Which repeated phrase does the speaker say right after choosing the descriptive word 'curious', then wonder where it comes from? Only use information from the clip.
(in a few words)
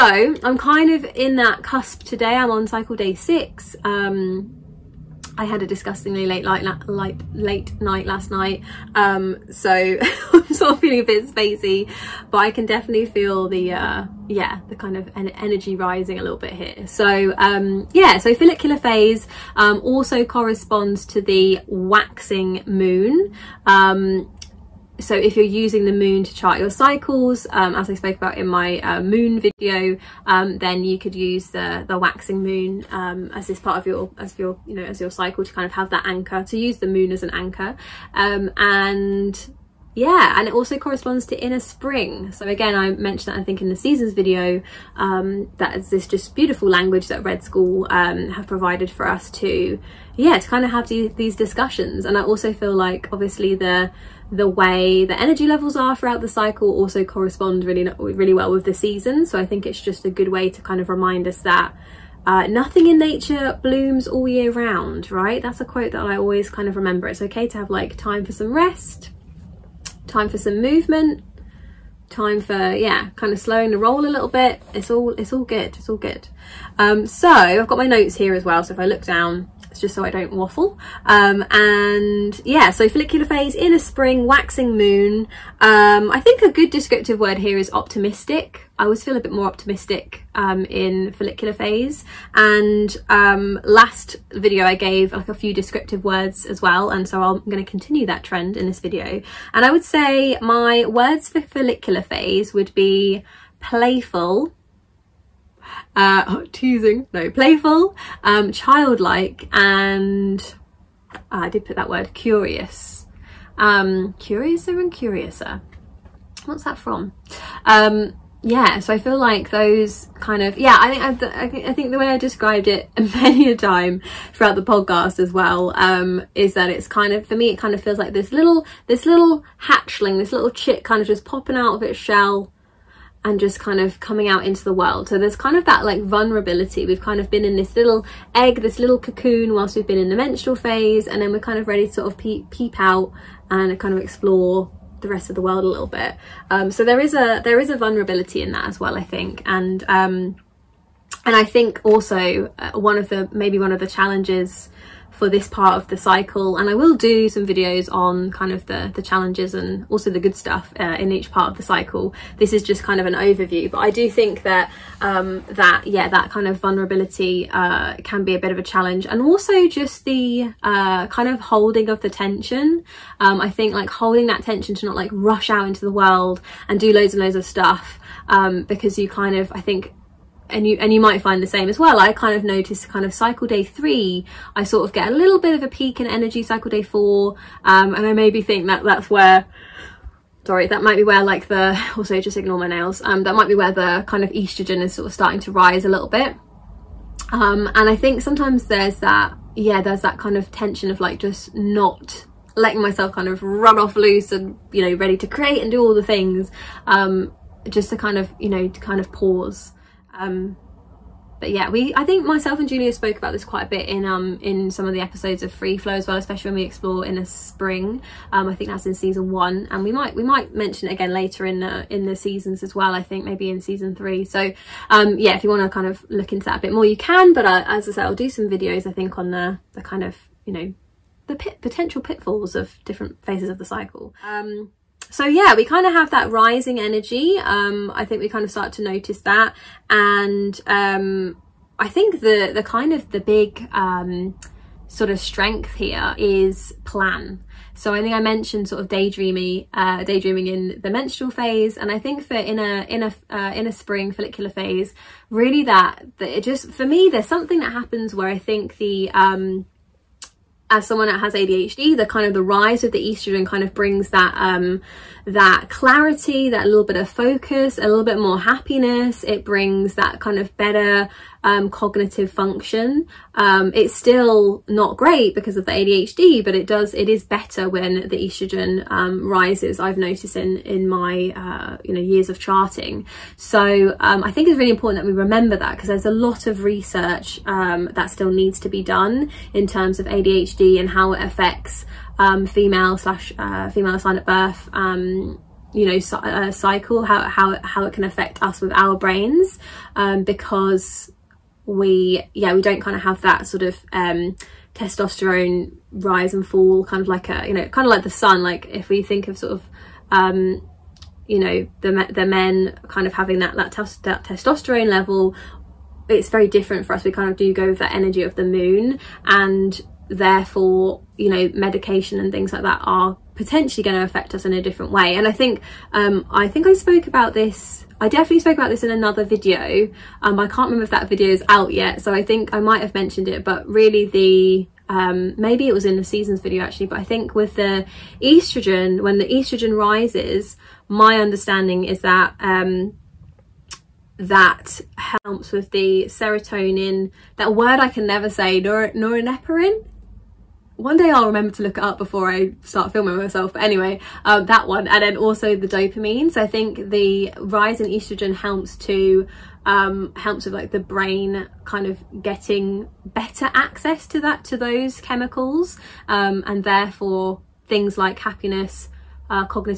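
Curiouser and curiouser.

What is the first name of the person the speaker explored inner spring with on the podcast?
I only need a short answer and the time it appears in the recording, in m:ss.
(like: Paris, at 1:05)
Julia, at 3:32.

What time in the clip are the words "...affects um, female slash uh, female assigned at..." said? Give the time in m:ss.
4:51.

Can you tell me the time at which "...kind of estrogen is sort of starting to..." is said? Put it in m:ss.
3:14.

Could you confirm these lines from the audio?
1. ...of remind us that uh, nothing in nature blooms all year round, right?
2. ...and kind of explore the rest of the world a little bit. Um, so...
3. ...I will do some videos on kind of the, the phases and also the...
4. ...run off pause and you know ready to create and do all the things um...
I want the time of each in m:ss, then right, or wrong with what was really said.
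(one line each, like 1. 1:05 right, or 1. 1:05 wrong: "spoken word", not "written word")
1. 1:00 right
2. 2:23 right
3. 2:36 wrong: "challenges", not "phases"
4. 3:23 wrong: "loose", not "pause".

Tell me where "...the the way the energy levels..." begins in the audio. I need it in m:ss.
0:53.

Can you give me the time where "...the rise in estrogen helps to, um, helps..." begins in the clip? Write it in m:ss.
5:56.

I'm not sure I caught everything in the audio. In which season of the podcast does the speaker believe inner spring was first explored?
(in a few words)
Season one.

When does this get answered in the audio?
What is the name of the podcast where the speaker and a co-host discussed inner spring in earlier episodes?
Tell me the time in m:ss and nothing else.
3:35.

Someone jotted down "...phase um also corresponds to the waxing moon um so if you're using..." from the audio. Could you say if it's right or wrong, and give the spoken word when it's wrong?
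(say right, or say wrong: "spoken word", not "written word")
right.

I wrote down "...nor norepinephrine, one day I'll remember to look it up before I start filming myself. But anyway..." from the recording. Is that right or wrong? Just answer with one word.
right.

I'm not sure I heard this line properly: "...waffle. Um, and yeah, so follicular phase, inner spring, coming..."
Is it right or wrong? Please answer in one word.
wrong.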